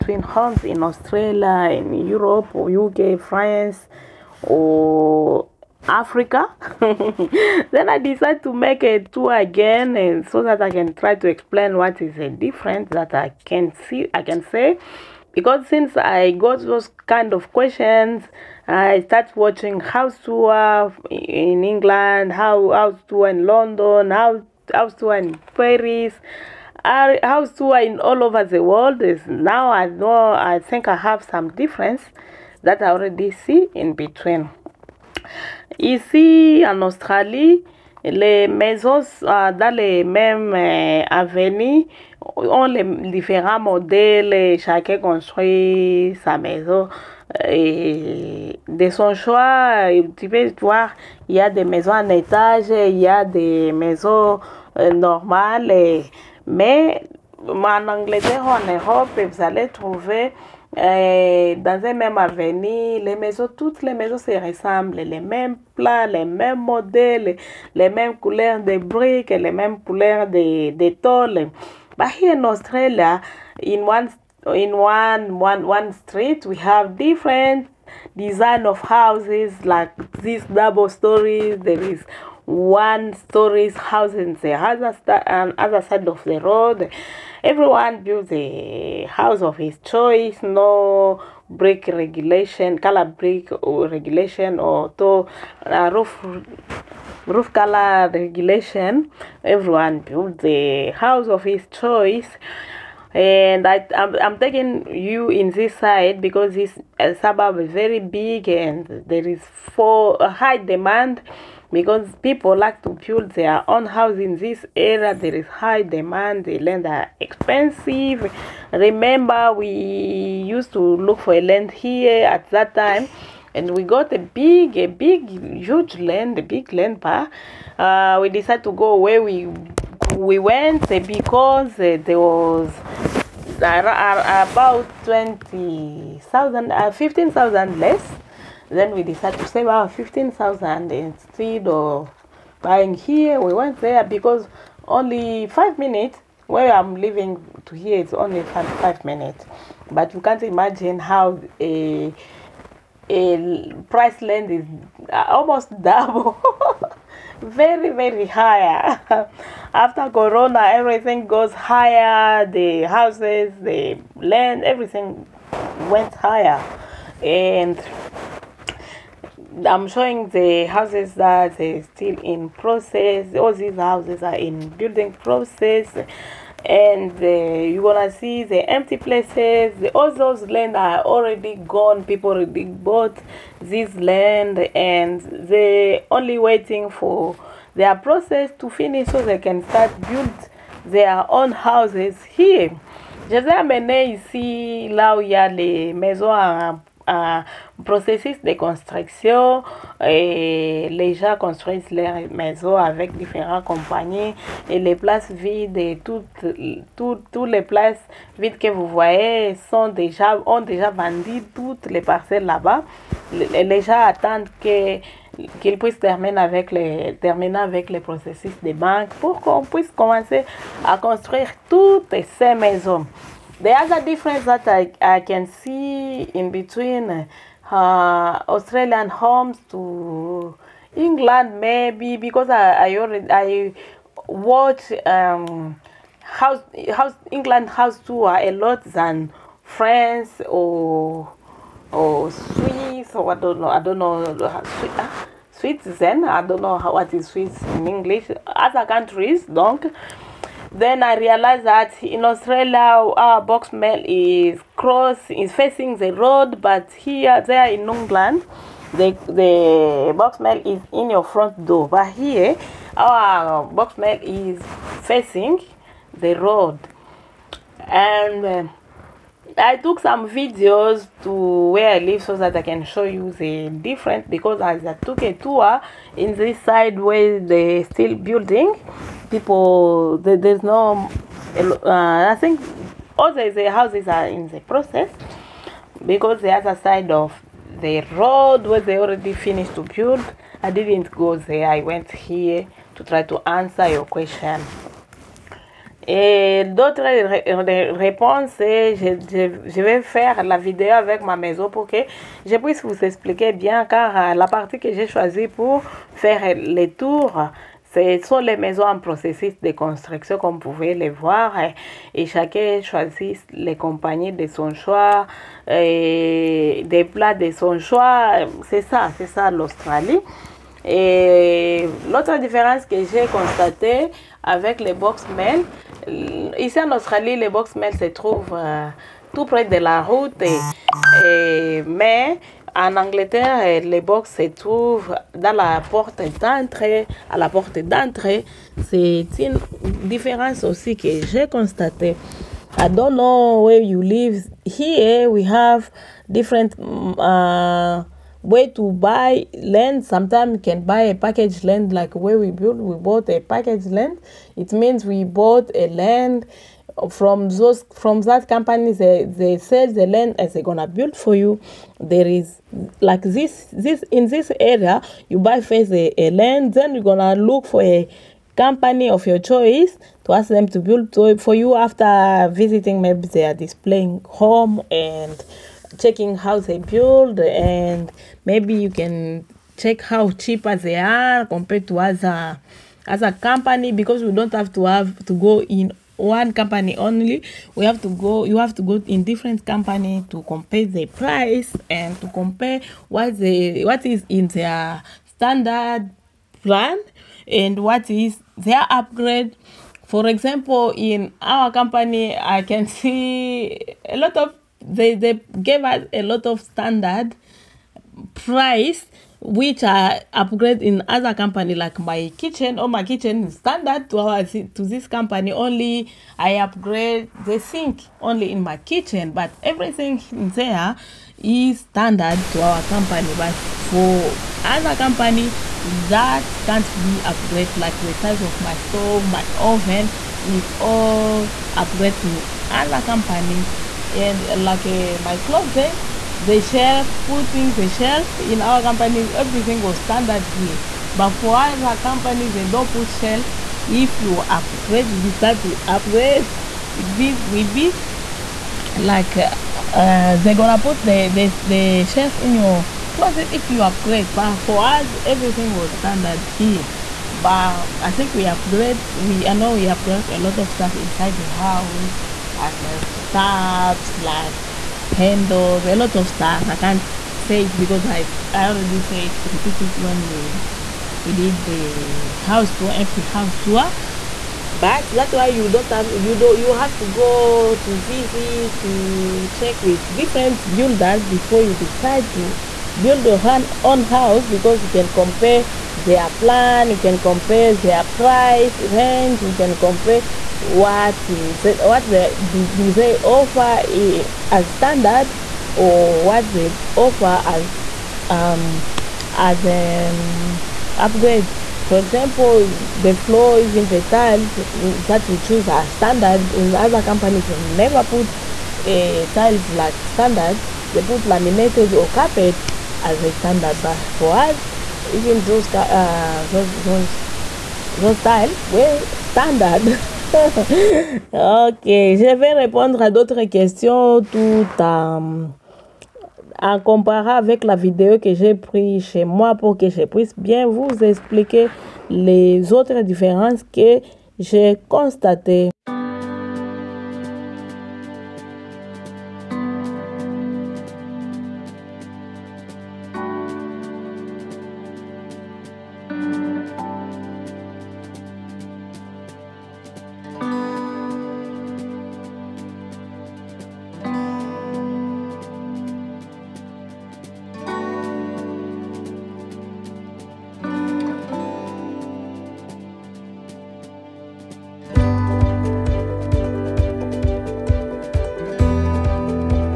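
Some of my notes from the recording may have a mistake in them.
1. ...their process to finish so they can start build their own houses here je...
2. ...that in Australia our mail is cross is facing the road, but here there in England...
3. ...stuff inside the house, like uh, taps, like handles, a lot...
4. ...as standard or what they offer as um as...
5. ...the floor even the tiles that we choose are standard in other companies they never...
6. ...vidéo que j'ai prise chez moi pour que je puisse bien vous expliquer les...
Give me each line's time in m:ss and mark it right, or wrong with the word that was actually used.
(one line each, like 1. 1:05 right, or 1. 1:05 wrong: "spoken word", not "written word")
1. 3:07 right
2. 4:11 right
3. 7:40 right
4. 8:14 right
5. 8:22 right
6. 8:47 right.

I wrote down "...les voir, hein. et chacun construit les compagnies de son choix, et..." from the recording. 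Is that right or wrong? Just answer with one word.
wrong.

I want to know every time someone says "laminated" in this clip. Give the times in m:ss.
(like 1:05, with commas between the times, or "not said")
8:31.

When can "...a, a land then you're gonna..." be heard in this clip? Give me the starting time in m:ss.
6:05.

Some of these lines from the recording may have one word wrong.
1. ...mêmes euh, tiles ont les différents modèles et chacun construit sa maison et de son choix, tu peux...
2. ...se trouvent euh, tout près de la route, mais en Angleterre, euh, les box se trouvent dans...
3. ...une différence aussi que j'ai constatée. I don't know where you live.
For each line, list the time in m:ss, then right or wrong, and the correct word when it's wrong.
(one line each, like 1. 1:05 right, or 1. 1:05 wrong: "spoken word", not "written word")
1. 0:40 wrong: "avenues", not "tiles"
2. 5:27 right
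3. 5:39 right.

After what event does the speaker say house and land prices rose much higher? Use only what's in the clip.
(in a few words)
Corona.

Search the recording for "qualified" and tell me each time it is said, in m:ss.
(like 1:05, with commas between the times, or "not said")
not said.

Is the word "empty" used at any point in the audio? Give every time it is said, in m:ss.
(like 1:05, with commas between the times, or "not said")
2:58, 7:52.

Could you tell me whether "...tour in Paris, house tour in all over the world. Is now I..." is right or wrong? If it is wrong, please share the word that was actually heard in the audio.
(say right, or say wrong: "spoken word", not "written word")
right.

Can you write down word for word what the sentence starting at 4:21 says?
But here our box mail is facing the road, and.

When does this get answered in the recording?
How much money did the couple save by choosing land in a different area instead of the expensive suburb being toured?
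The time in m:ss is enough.
2:16.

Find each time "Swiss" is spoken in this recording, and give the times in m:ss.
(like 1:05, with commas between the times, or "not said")
4:02, 4:07.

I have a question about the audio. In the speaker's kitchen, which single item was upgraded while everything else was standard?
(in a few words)
The sink.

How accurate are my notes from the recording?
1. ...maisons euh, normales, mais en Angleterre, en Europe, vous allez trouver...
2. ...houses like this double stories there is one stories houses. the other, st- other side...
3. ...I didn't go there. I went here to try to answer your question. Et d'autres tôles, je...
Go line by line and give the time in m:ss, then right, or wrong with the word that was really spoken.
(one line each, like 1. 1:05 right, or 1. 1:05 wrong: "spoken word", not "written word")
1. 0:53 right
2. 1:18 right
3. 4:50 wrong: "réponses", not "tôles".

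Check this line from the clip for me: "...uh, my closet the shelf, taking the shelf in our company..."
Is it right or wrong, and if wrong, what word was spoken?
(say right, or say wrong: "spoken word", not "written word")
wrong: "putting", not "taking".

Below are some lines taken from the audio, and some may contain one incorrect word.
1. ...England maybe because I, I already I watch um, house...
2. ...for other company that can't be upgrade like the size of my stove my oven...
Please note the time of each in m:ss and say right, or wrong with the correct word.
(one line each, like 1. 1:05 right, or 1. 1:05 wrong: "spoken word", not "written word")
1. 3:50 right
2. 7:03 right.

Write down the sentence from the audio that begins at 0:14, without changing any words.
I can say because since I got those kind of questions.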